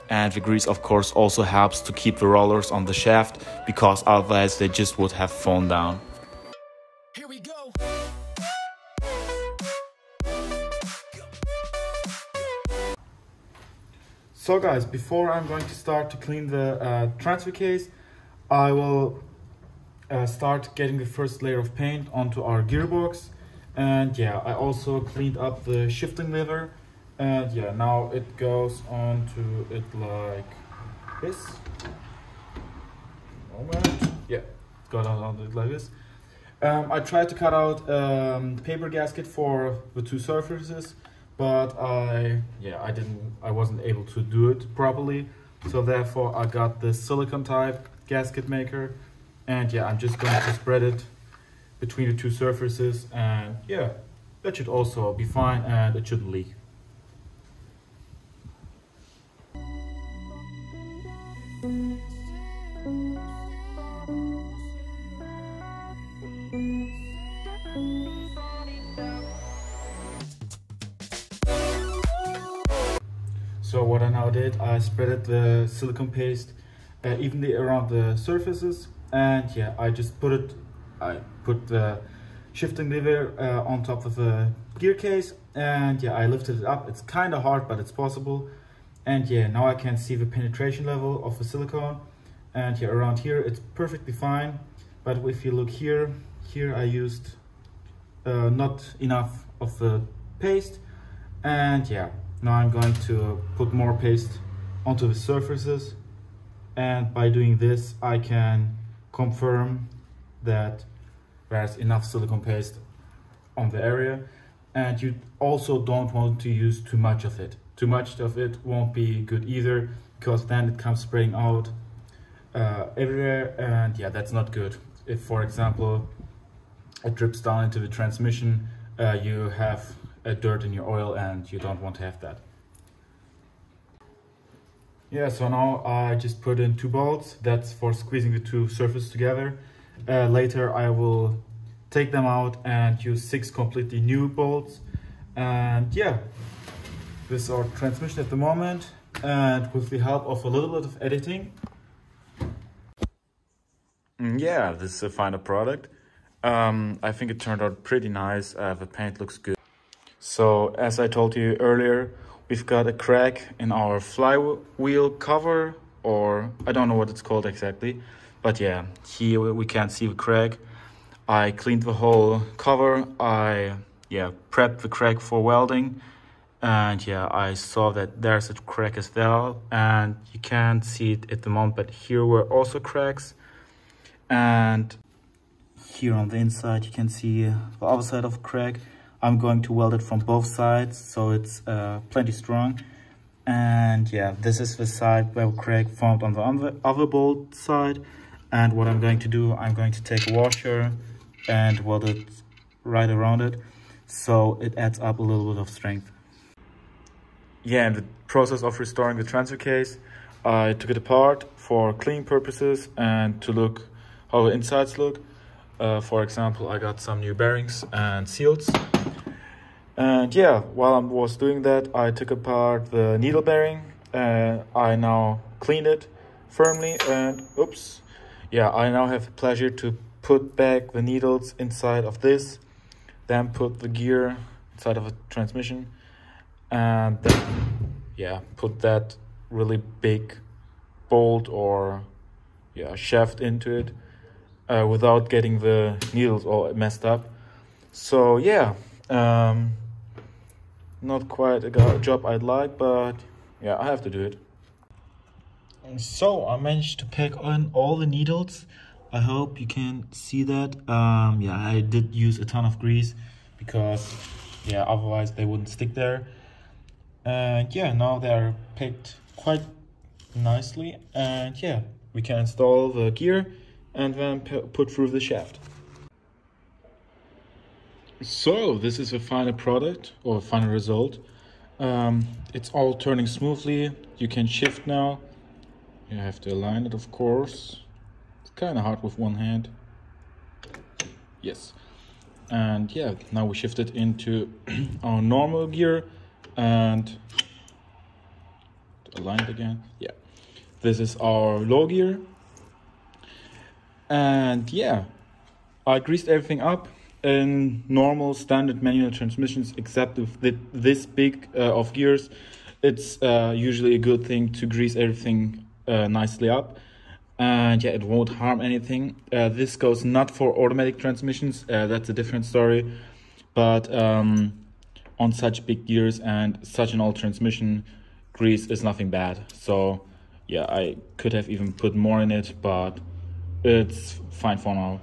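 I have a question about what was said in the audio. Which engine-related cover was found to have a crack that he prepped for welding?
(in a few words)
flywheel cover.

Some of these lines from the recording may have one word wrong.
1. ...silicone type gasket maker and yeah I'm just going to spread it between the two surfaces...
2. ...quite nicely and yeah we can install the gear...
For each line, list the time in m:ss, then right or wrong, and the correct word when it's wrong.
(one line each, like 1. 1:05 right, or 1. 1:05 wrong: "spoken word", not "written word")
1. 0:46 right
2. 4:29 right.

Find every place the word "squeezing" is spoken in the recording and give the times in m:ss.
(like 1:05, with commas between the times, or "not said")
2:17.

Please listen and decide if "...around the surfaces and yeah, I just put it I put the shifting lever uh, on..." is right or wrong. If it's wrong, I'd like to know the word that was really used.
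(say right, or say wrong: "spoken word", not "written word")
right.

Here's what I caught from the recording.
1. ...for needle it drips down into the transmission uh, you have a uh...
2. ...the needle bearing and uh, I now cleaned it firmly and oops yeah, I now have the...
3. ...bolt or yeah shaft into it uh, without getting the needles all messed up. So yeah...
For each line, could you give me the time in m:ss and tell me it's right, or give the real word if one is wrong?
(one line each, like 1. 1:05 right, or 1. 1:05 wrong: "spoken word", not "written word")
1. 2:05 wrong: "example", not "needle"
2. 3:42 right
3. 4:01 right.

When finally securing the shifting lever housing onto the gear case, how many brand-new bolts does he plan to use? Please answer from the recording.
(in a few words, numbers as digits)
6.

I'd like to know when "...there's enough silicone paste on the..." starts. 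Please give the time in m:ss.
1:51.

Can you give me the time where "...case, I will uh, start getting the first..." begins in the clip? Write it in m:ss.
0:17.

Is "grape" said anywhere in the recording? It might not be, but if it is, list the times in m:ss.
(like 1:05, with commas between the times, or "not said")
not said.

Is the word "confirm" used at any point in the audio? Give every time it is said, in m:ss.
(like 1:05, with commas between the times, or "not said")
1:49.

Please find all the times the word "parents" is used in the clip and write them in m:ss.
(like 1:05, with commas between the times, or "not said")
not said.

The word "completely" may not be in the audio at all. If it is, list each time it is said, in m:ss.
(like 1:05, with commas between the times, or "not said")
2:23.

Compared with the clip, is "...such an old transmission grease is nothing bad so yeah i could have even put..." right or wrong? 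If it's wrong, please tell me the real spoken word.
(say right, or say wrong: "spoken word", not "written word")
right.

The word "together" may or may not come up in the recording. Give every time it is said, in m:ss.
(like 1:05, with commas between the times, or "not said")
2:19.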